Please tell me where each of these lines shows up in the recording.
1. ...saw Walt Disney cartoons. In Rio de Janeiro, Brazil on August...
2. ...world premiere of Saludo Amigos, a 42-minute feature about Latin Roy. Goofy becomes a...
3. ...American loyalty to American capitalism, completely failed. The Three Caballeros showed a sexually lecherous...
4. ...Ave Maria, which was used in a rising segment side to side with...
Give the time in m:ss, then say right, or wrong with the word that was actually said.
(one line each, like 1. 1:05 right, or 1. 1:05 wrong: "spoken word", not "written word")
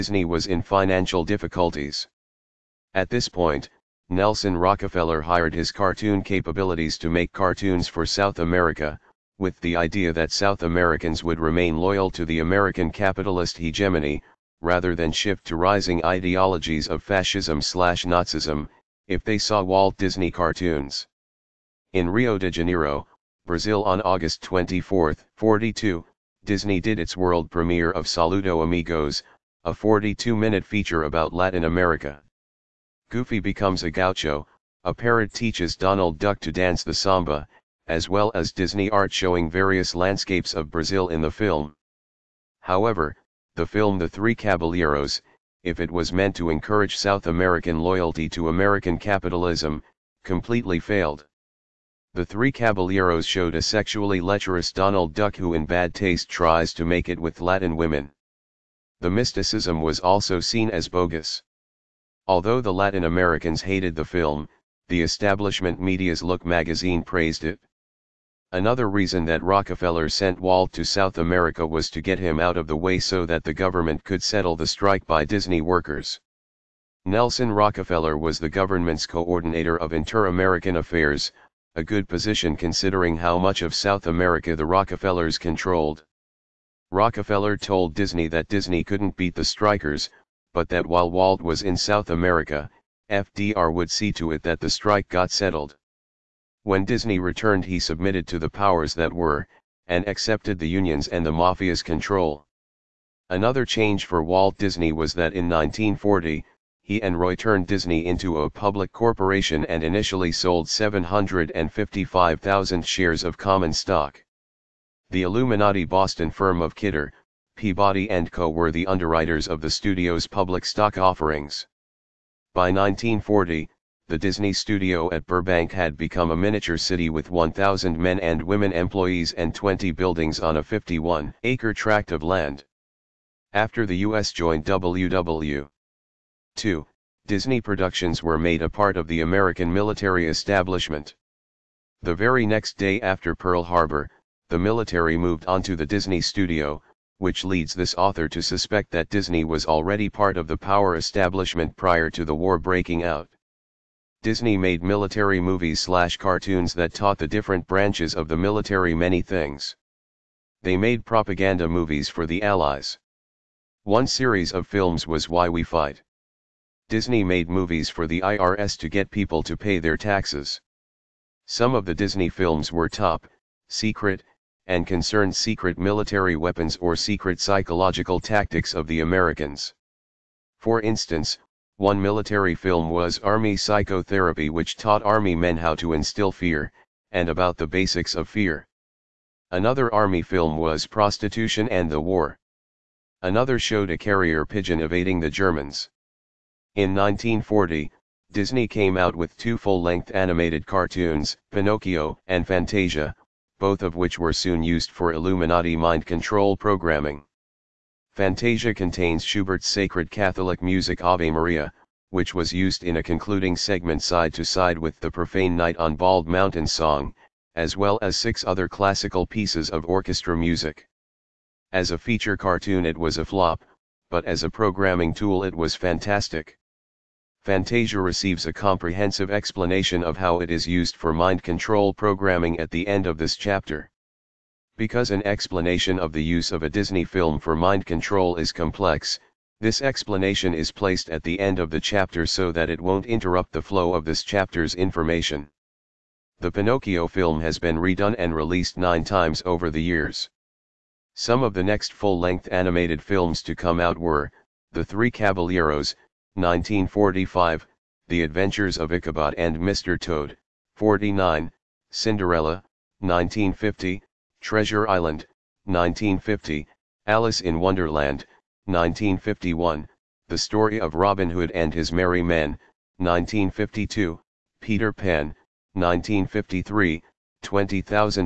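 1. 0:19 right
2. 0:27 wrong: "America", not "Roy"
3. 0:47 right
4. 3:31 wrong: "concluding", not "rising".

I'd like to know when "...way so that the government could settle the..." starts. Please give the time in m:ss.
1:12.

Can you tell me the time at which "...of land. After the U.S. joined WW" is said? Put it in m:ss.
2:12.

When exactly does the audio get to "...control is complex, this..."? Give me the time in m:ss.
3:57.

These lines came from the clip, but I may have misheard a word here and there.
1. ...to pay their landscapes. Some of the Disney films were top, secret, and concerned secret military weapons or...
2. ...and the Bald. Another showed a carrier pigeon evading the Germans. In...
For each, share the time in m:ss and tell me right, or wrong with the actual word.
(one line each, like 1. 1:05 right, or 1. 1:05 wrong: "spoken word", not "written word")
1. 2:49 wrong: "taxes", not "landscapes"
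2. 3:11 wrong: "War", not "Bald".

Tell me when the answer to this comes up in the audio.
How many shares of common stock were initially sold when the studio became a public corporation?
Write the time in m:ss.
1:50.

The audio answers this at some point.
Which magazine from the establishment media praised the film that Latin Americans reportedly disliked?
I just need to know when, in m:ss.
1:06.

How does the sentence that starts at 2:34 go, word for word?
Disney made military movies slash cartoons that taught the different branches of the military many things.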